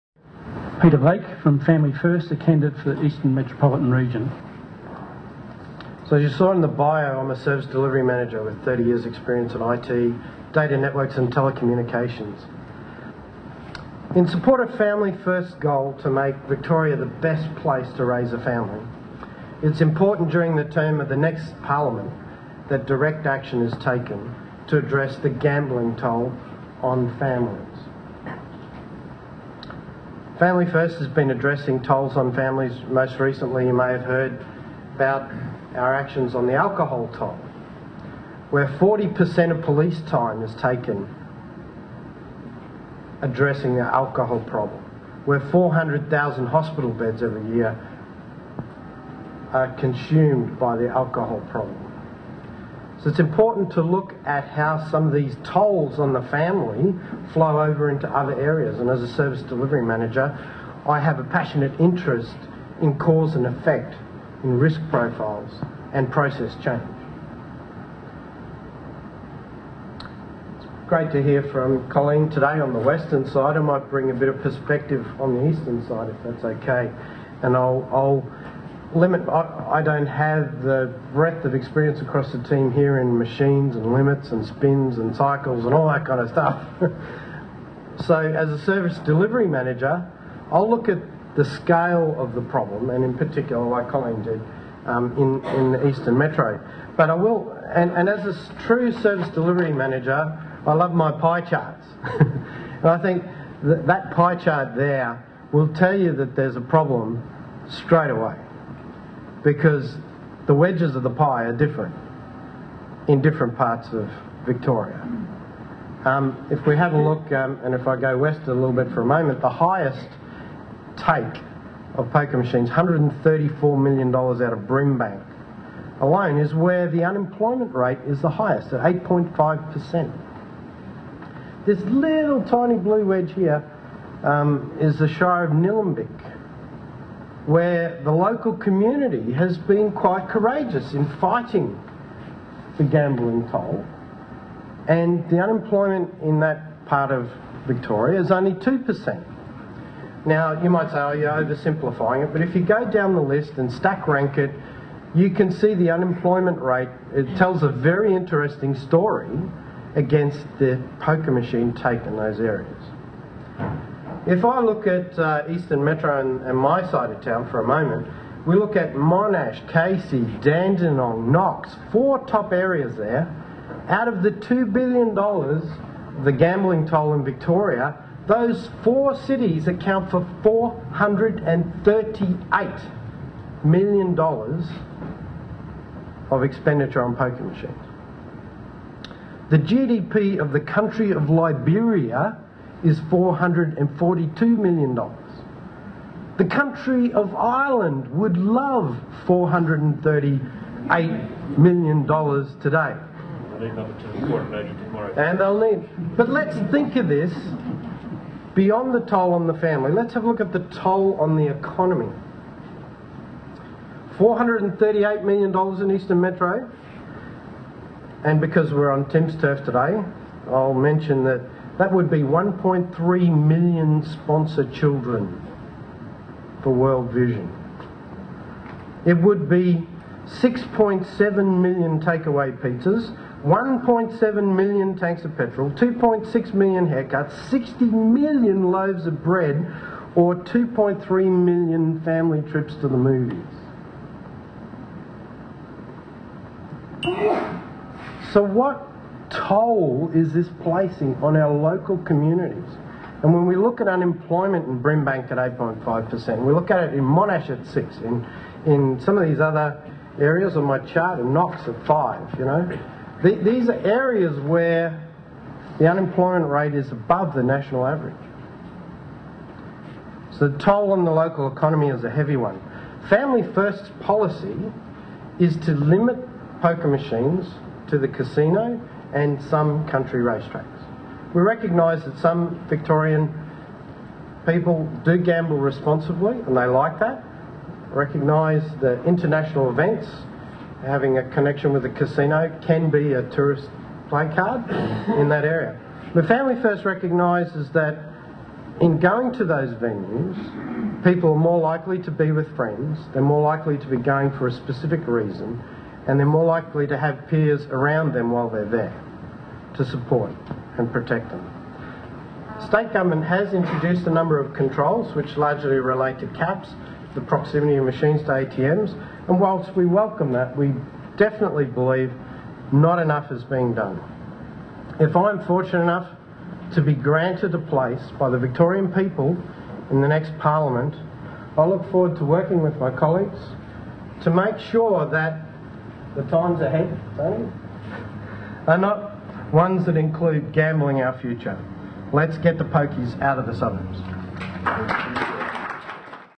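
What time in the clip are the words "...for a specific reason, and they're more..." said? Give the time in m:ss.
5:04.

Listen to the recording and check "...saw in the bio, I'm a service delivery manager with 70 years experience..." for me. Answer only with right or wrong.
wrong.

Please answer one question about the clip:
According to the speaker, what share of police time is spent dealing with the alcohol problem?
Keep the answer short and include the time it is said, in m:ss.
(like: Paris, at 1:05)
40%, at 0:38.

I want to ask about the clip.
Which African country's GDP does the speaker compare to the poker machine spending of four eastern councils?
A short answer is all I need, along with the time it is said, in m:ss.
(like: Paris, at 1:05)
Liberia, at 3:11.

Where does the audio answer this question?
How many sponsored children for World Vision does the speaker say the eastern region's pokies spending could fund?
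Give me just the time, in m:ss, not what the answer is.
3:42.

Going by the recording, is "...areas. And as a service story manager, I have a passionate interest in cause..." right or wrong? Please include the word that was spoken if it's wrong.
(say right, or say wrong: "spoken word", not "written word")
wrong: "delivery", not "story".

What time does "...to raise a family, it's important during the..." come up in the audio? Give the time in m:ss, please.
0:17.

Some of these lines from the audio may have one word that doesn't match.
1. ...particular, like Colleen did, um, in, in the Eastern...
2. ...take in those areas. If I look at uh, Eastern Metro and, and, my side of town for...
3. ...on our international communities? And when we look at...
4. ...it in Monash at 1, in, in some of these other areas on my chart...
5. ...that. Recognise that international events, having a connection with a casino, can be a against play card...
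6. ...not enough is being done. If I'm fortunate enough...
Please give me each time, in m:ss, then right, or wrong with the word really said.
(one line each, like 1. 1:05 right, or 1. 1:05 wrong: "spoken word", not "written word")
1. 1:33 right
2. 2:41 right
3. 4:11 wrong: "local", not "international"
4. 4:16 wrong: "6", not "1"
5. 4:46 wrong: "tourist", not "against"
6. 5:22 right.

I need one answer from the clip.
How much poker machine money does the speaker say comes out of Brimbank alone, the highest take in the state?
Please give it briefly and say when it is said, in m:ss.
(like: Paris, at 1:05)
$134 million, at 2:02.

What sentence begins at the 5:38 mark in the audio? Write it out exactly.
are not ones that include gambling our future.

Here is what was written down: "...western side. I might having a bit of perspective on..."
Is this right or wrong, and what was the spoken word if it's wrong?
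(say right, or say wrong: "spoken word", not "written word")
wrong: "bring", not "having".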